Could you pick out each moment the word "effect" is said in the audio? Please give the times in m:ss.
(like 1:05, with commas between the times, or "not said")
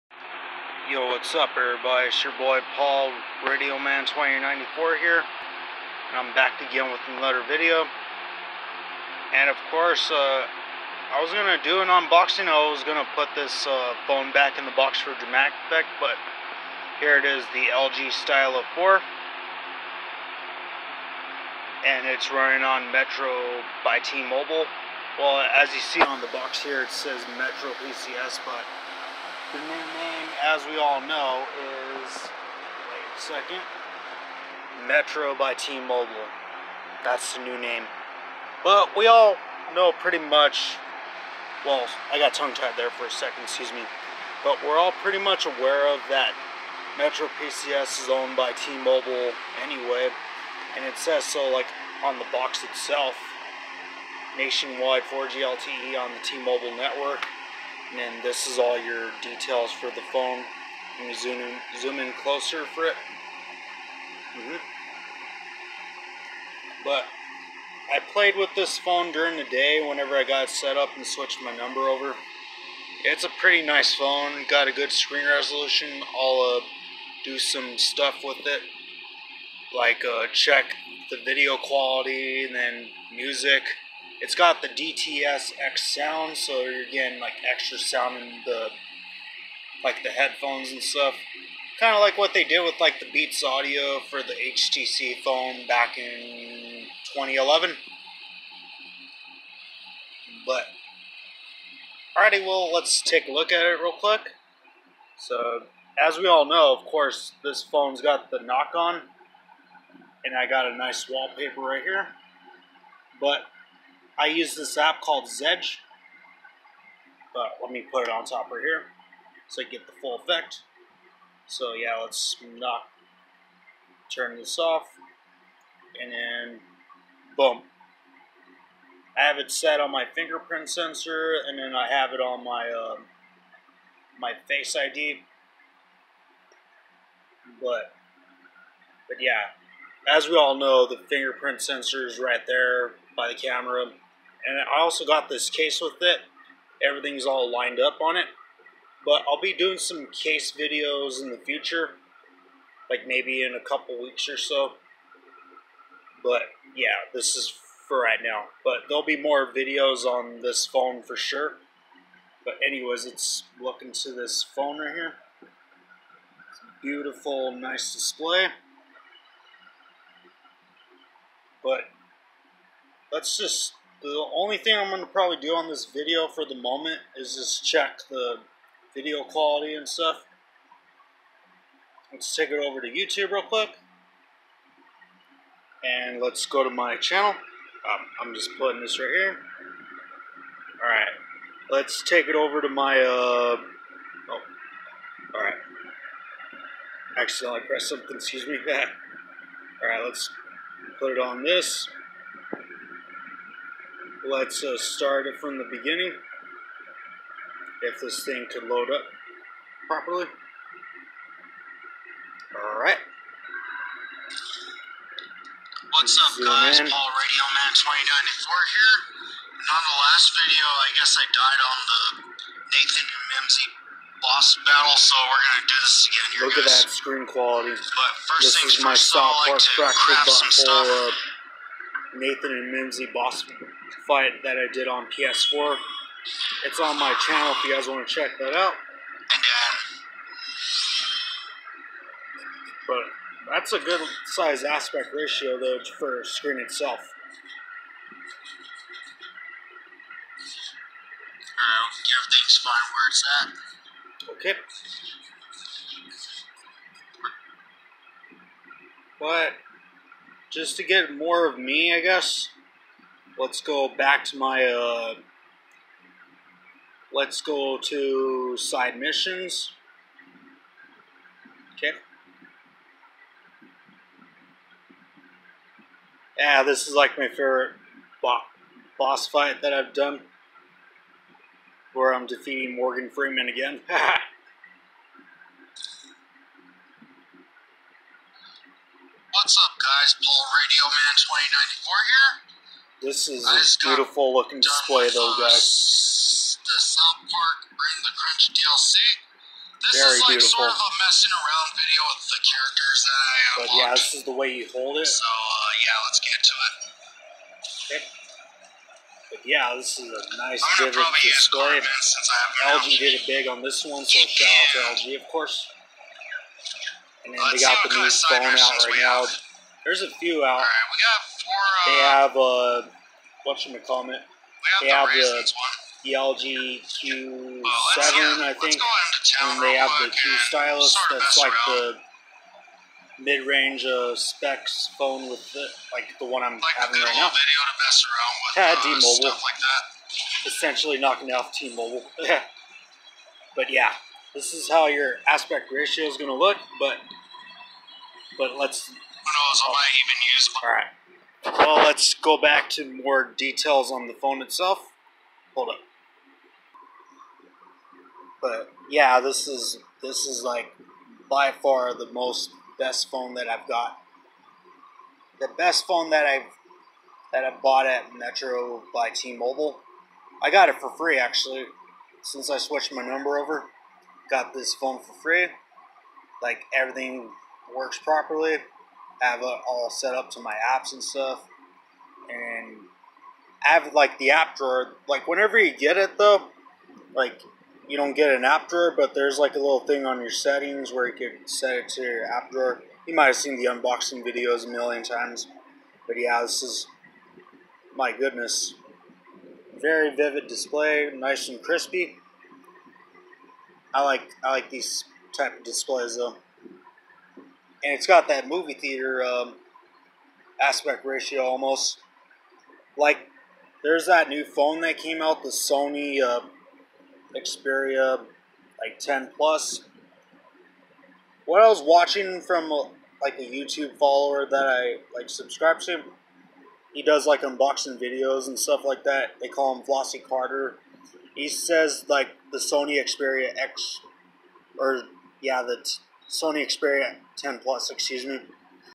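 0:15, 2:00.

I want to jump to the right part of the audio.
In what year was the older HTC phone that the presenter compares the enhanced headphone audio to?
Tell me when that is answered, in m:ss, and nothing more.
1:37.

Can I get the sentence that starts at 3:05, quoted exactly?
And let's go to my channel.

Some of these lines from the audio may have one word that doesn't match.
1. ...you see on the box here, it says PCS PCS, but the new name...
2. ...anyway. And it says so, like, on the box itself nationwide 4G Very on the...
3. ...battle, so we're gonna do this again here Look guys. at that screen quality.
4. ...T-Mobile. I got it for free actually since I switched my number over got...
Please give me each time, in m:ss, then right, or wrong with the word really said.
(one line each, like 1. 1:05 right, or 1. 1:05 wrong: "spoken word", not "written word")
1. 0:25 wrong: "Metro", not "PCS"
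2. 0:49 wrong: "LTE", not "Very"
3. 3:44 right
4. 6:09 right.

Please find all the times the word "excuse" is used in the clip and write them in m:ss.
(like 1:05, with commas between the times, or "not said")
0:43, 3:18, 7:17.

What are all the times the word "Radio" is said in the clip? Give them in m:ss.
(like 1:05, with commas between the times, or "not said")
0:03, 3:37, 4:50.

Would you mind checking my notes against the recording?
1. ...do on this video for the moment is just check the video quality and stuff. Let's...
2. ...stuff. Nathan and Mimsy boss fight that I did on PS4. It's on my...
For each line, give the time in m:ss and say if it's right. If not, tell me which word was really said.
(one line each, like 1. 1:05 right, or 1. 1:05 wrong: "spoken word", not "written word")
1. 2:55 right
2. 3:50 right.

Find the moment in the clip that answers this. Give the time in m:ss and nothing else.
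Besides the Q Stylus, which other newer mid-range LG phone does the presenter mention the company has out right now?
5:26.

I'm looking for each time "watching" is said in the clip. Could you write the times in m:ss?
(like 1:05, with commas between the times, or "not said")
7:01.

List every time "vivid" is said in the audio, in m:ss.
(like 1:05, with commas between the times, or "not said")
5:10, 6:40.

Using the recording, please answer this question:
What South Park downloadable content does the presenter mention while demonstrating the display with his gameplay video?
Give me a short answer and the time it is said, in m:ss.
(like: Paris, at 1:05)
Bring the Crunch, at 4:57.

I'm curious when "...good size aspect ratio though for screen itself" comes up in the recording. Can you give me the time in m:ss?
4:03.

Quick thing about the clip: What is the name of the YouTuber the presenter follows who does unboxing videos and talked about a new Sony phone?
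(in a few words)
Flossy Carter.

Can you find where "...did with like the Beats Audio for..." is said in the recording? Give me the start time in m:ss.
1:32.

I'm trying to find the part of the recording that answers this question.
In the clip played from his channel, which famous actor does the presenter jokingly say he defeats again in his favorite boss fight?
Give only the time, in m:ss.
4:42.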